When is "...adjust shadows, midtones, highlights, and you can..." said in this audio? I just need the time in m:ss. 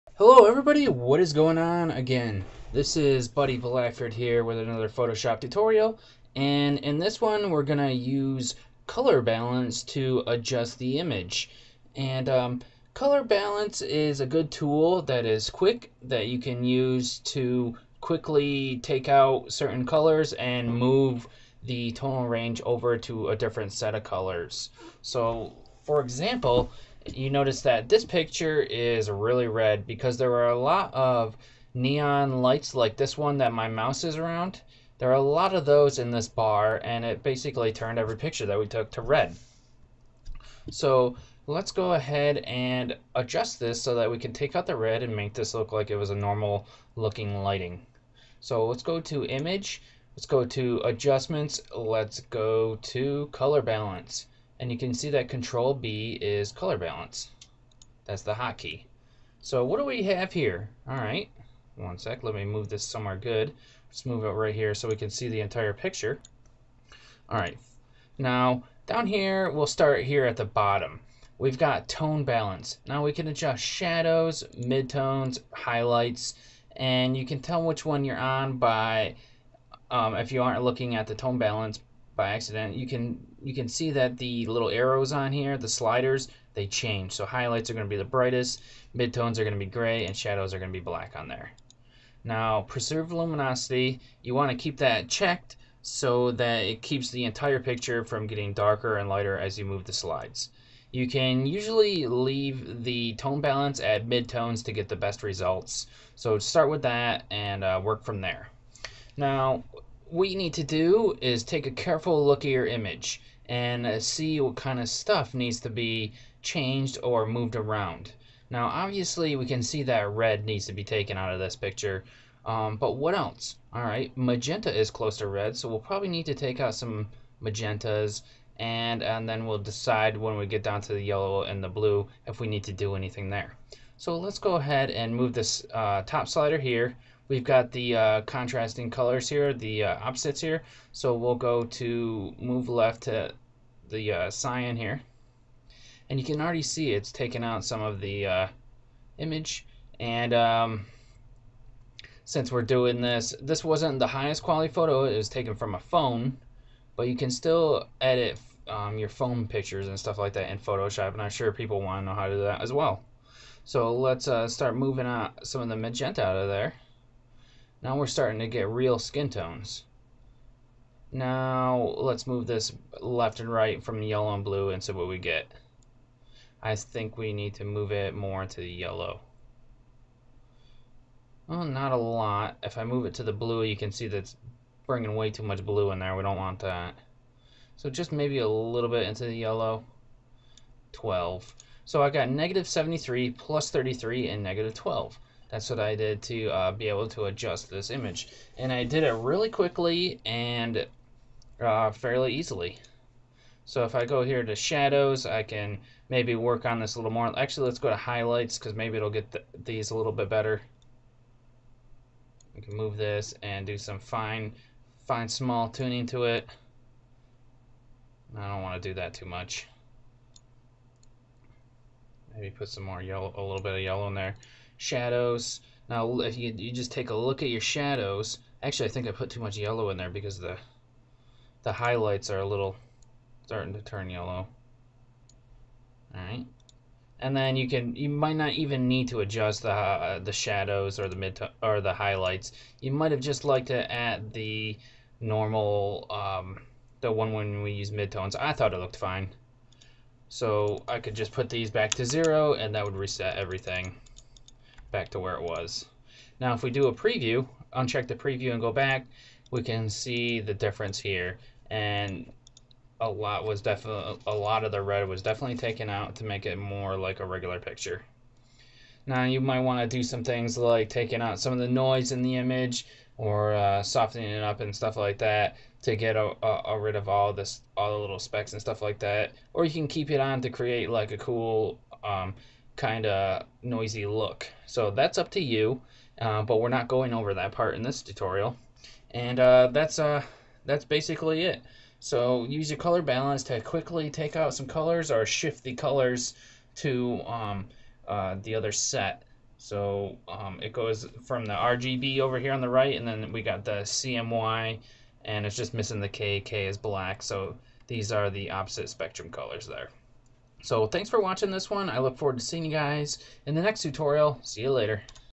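1:13.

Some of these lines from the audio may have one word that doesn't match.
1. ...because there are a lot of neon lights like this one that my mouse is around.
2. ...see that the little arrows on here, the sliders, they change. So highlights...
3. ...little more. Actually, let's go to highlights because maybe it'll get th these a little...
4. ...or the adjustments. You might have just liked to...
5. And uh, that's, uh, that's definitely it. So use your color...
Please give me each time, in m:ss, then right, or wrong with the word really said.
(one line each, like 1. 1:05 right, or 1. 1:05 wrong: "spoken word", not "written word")
1. 0:29 right
2. 1:23 right
3. 3:26 right
4. 4:01 wrong: "highlights", not "adjustments"
5. 4:49 wrong: "basically", not "definitely".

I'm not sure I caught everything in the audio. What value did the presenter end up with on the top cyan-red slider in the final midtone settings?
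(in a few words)
-73.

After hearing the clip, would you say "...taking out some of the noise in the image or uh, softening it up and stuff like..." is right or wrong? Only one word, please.
right.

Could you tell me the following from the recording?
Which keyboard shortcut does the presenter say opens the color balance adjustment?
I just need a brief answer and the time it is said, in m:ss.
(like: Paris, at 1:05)
Control B, at 0:55.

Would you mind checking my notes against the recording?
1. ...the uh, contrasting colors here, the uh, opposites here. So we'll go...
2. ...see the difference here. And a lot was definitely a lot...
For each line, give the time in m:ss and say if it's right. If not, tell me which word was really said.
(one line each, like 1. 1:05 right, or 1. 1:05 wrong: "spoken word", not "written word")
1. 2:17 right
2. 4:19 right.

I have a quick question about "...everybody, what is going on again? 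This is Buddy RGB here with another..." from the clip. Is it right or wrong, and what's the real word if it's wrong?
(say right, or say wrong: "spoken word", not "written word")
wrong: "Blackford", not "RGB".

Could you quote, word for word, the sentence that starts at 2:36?
But you can still edit um, your phone pictures and stuff like that in Photoshop.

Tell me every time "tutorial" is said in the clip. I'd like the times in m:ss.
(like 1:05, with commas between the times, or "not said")
0:05, 4:48, 5:13.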